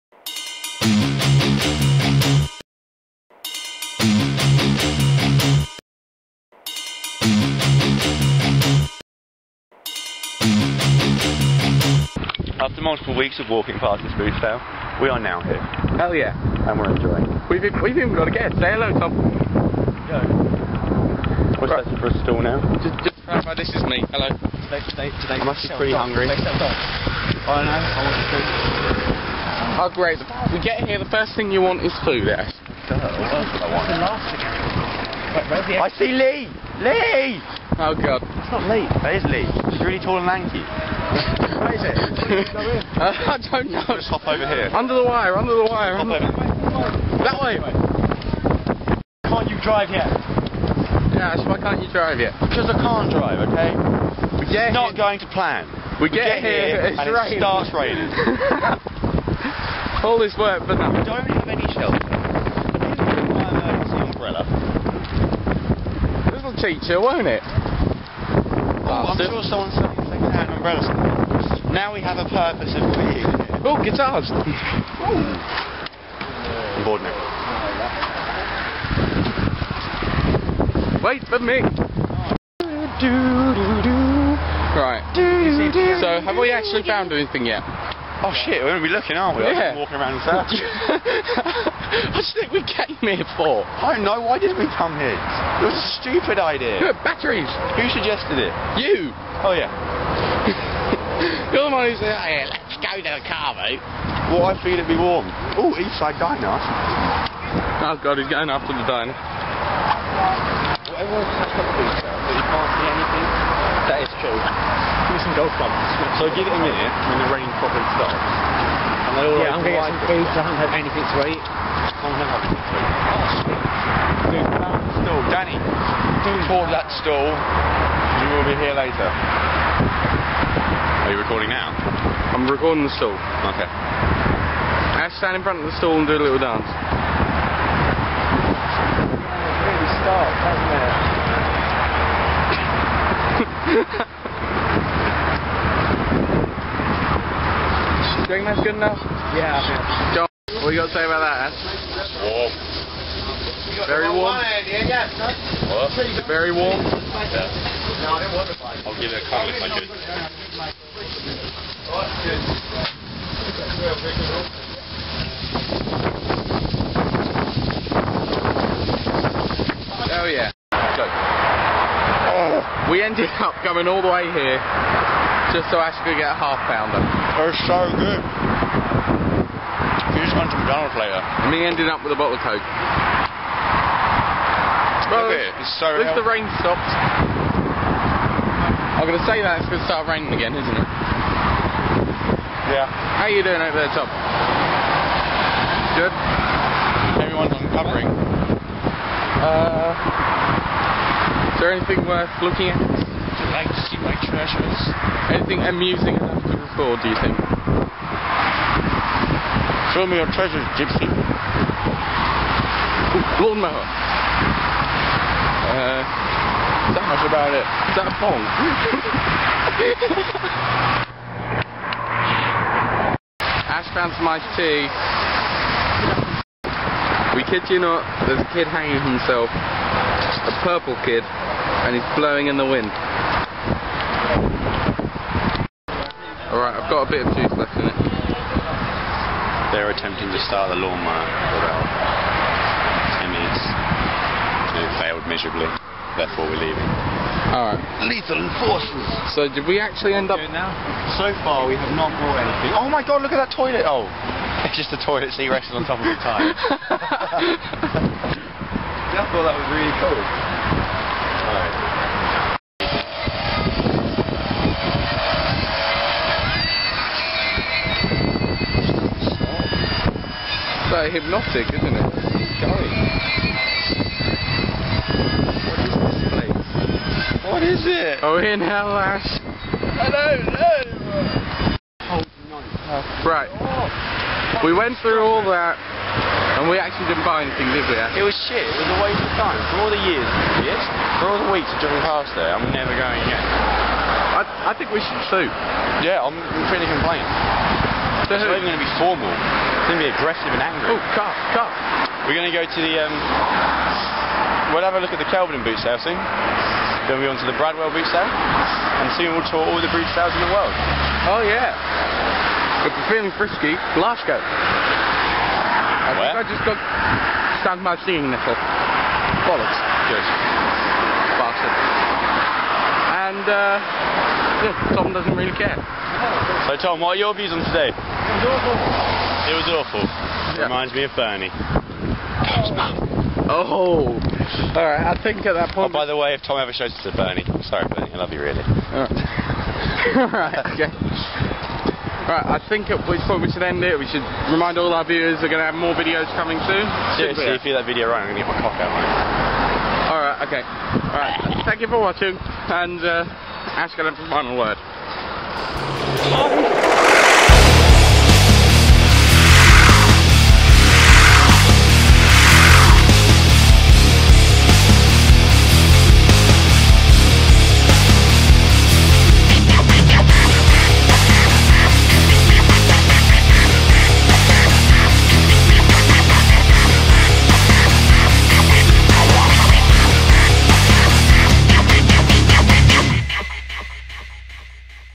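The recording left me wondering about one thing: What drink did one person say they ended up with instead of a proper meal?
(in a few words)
Coke.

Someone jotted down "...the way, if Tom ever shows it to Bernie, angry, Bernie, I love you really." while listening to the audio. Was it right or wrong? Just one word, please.
wrong.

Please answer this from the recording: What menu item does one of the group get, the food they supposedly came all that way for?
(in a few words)
half pounder.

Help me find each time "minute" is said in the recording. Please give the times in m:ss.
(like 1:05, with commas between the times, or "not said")
1:56.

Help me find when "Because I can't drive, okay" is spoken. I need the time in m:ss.
0:52.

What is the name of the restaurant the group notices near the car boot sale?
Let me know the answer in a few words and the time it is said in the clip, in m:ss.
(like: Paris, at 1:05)
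Eastside Diner, at 1:45.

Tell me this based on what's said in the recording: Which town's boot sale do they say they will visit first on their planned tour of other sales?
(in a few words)
Kelvedon.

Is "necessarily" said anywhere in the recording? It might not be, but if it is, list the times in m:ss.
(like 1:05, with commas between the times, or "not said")
not said.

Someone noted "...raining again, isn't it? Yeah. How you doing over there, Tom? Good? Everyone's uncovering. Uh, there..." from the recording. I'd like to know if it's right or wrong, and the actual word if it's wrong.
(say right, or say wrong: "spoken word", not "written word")
right.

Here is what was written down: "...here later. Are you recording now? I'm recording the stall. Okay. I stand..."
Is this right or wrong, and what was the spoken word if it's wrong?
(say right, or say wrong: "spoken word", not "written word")
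right.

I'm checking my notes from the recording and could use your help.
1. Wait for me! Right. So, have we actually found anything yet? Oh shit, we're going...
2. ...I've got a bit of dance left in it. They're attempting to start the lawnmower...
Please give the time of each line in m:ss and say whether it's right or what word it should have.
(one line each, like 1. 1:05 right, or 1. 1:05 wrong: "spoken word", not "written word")
1. 1:21 right
2. 3:56 wrong: "juice", not "dance".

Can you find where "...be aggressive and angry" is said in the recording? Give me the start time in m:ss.
5:00.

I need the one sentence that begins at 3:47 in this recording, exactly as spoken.
We kid you not, there's a kid hanging himself a purple kid and he's blowing in the wind.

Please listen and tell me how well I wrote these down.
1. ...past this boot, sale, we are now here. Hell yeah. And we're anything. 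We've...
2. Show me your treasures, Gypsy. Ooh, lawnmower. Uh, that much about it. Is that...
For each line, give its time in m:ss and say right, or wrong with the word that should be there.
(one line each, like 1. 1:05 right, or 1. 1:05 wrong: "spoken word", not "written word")
1. 0:13 wrong: "enjoying", not "anything"
2. 3:29 right.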